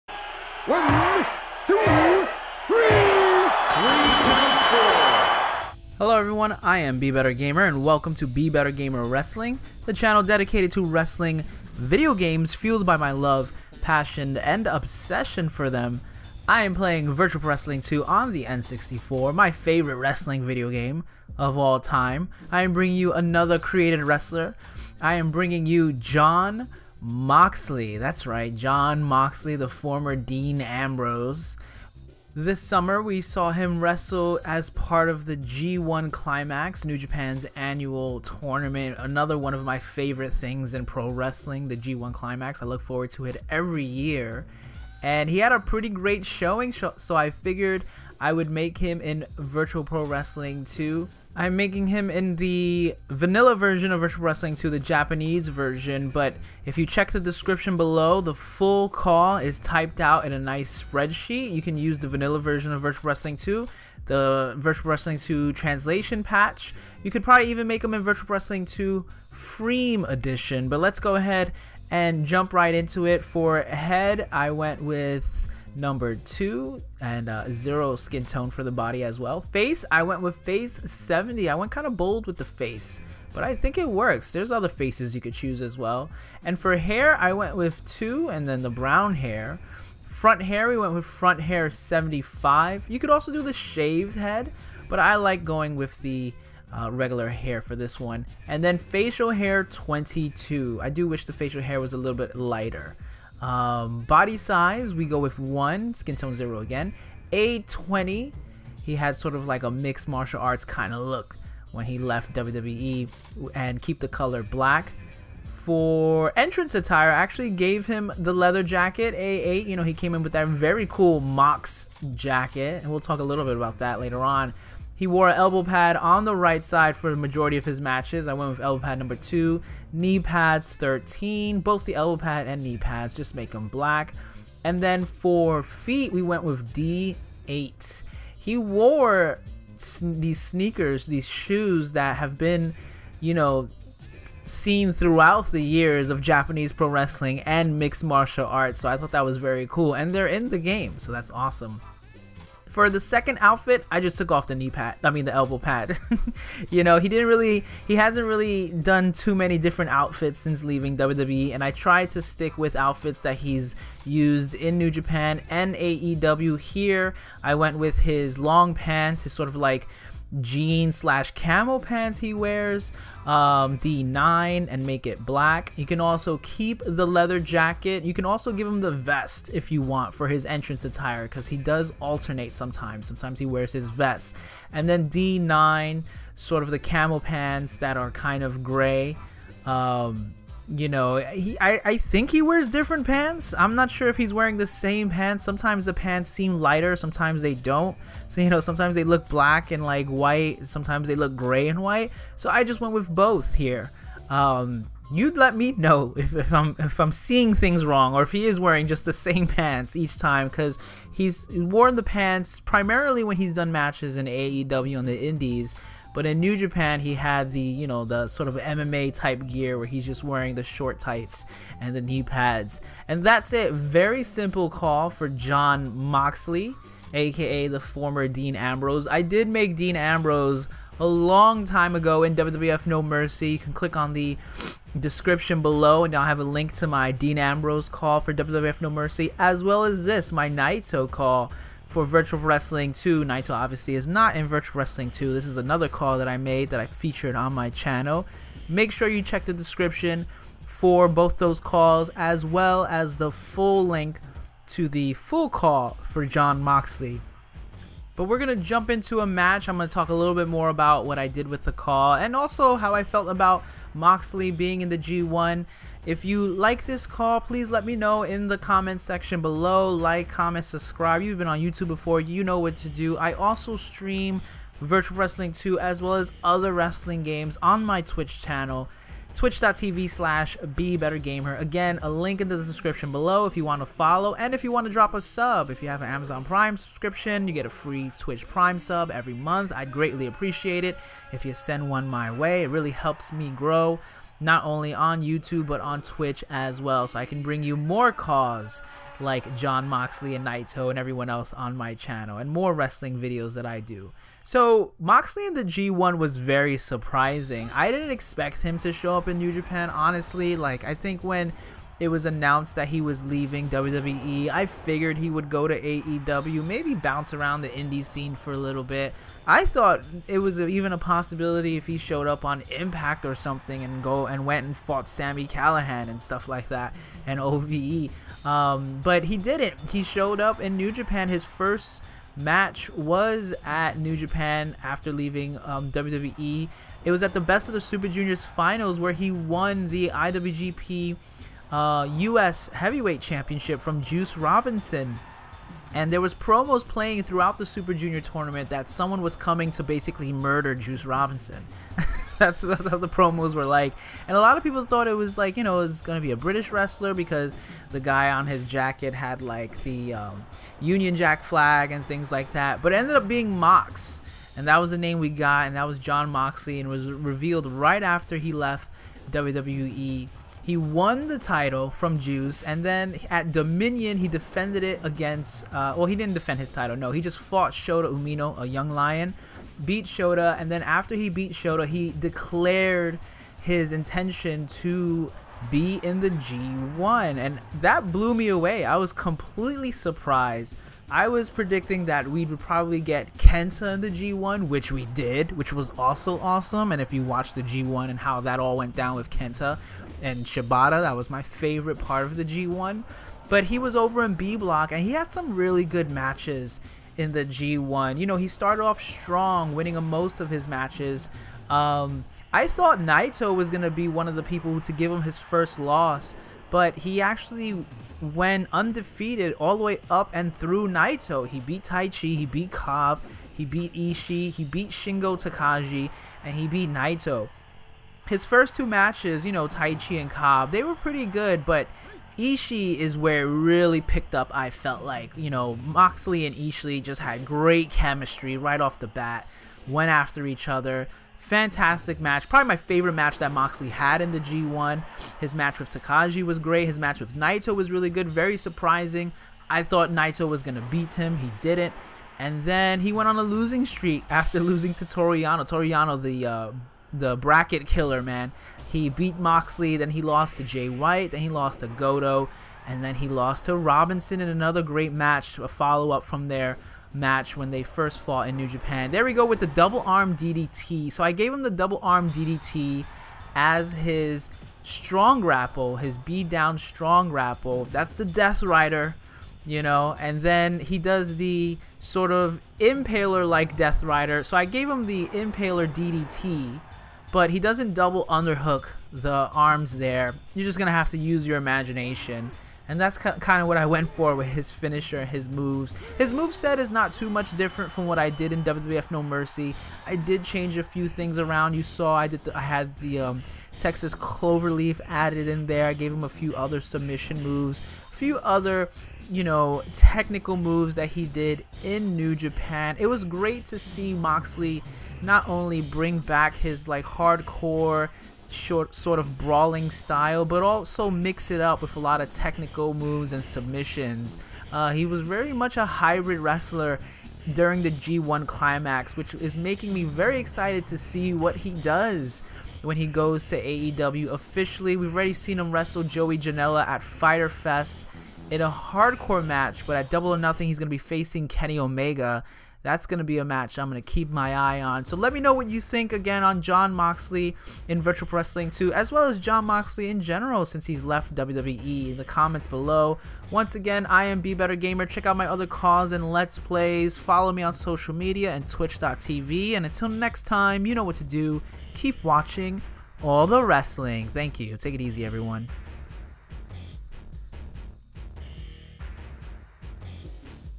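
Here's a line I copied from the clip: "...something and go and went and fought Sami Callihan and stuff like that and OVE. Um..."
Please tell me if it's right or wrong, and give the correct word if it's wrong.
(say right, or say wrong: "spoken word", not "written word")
right.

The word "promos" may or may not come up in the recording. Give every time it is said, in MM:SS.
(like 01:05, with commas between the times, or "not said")
05:46, 05:53.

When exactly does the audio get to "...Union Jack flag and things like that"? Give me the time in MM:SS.
06:00.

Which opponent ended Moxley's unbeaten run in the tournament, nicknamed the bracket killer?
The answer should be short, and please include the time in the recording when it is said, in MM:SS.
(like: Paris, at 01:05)
Toru Yano, at 07:35.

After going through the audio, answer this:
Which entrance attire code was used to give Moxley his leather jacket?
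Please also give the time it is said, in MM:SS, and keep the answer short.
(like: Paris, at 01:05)
A8, at 01:59.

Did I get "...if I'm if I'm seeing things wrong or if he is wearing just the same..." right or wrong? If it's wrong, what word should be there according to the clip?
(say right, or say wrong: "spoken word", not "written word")
right.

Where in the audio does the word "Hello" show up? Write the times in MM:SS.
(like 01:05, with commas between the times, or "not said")
00:05.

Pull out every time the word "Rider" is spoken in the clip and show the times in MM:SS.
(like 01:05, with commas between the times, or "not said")
07:58, 08:04.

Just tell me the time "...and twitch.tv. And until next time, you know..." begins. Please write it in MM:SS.
09:18.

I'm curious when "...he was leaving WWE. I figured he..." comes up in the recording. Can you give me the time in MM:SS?
05:12.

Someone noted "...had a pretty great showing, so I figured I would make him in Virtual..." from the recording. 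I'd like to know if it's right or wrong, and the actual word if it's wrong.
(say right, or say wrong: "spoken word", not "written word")
right.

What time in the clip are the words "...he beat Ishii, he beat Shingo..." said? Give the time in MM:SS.
07:03.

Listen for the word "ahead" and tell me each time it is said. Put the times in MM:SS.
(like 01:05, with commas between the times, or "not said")
01:11.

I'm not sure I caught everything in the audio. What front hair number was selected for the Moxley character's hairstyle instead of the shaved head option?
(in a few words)
75.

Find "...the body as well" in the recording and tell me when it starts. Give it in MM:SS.
01:18.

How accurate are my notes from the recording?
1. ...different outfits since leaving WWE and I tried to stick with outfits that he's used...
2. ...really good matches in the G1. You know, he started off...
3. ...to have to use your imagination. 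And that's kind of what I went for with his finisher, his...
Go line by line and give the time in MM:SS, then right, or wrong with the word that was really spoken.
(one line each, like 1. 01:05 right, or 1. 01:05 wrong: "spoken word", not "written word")
1. 02:39 right
2. 06:45 right
3. 08:10 right.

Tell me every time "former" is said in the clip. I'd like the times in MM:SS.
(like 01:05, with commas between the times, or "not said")
00:29, 03:47.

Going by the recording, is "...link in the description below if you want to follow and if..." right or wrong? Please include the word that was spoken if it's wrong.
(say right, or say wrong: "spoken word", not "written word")
right.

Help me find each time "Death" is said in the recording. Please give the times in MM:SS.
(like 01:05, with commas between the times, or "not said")
07:58, 08:03.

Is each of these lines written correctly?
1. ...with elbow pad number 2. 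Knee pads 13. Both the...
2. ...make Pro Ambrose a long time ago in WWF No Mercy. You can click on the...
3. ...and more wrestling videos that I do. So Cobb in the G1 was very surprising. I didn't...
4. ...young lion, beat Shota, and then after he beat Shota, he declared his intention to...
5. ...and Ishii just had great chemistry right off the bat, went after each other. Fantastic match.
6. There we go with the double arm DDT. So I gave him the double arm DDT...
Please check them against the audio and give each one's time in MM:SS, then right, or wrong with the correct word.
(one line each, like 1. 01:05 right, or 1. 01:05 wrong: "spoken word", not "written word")
1. 02:08 right
2. 03:49 wrong: "Dean", not "Pro"
3. 05:02 wrong: "Moxley", not "Cobb"
4. 06:18 right
5. 07:16 right
6. 07:49 right.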